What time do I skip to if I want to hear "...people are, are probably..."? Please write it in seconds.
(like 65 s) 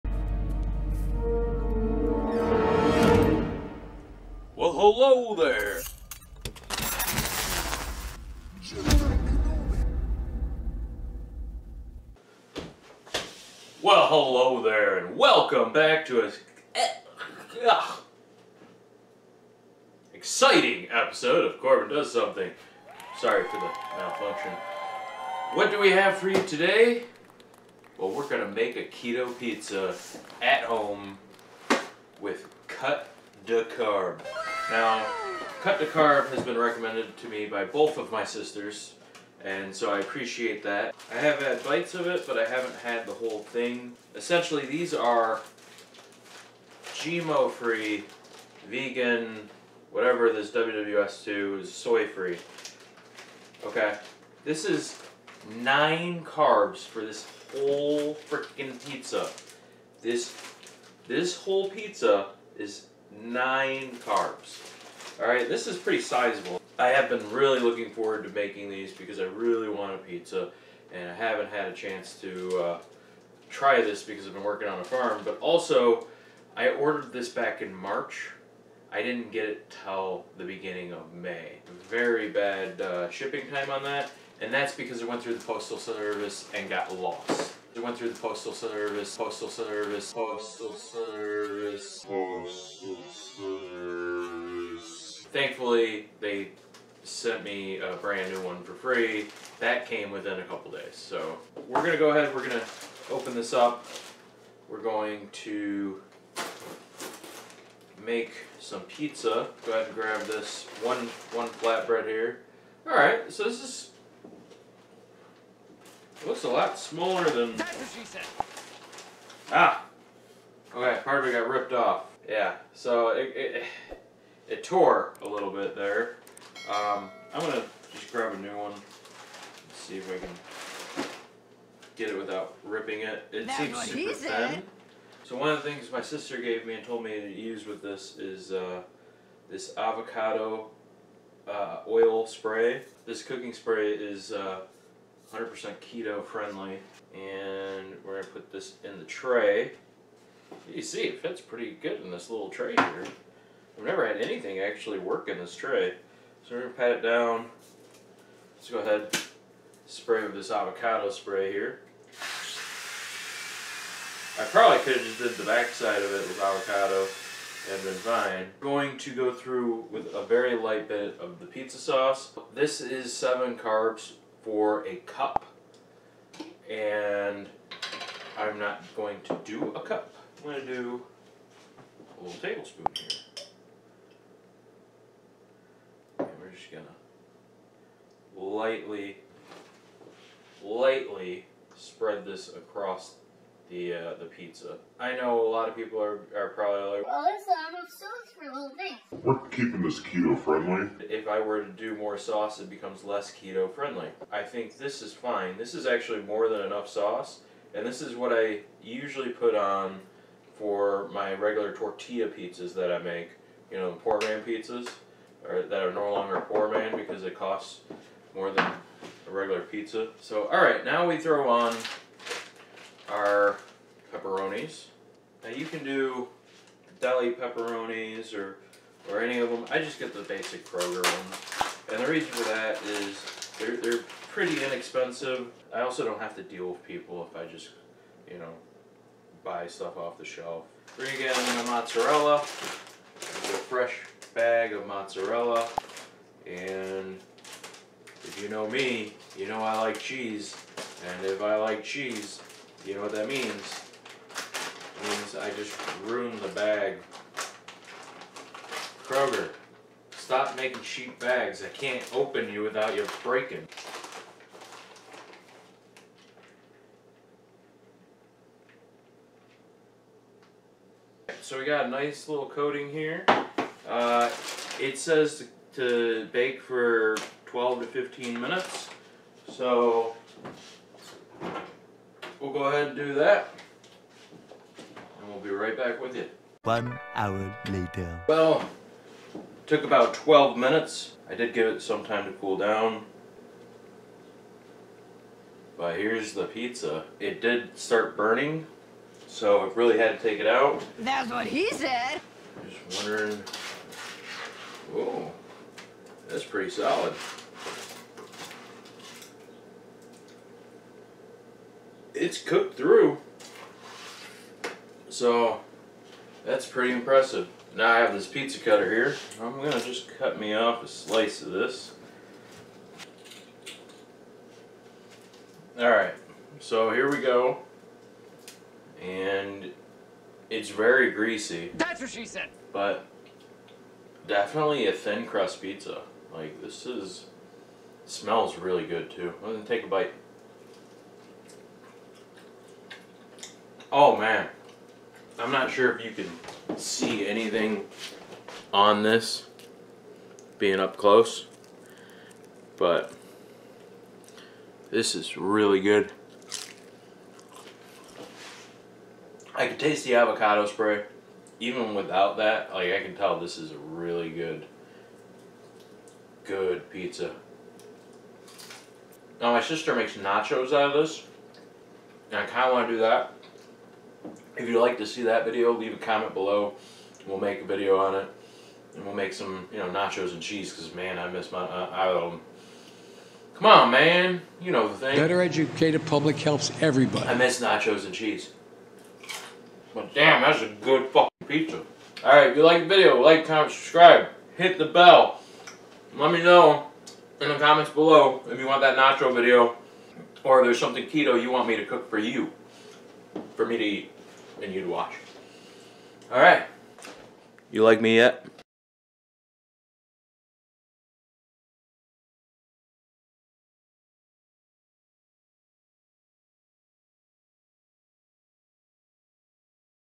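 195 s.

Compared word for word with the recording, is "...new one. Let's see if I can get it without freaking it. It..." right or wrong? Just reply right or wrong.
wrong.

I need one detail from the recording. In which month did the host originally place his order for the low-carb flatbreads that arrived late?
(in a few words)
March.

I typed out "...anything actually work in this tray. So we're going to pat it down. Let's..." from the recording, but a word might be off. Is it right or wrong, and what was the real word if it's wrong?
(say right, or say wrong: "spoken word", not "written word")
right.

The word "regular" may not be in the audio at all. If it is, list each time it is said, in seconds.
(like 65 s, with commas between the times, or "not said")
211 s, 219 s.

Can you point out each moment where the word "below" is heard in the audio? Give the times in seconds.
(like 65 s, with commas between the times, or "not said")
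376 s, 397 s.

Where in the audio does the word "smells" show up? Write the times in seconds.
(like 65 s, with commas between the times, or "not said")
338 s.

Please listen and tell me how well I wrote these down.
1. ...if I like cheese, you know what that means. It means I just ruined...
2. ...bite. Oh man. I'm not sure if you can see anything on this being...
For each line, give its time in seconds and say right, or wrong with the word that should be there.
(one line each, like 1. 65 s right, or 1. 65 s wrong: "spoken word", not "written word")
1. 251 s right
2. 339 s right.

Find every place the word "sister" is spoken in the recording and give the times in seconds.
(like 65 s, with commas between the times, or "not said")
38 s, 136 s, 369 s.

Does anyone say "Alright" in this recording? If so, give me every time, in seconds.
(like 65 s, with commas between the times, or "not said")
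325 s, 392 s, 406 s.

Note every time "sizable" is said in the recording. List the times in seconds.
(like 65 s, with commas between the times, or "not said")
66 s.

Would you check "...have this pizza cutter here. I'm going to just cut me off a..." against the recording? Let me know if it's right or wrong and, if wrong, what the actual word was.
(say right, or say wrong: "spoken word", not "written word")
right.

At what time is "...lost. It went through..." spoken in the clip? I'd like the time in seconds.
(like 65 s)
86 s.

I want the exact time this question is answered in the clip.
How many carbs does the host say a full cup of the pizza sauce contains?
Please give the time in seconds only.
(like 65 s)
173 s.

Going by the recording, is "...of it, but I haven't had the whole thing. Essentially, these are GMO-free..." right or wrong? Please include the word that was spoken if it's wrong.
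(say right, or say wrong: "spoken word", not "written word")
right.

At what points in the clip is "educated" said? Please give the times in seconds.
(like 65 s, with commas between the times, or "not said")
385 s.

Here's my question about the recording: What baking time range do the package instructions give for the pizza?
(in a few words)
12 to 15 minutes.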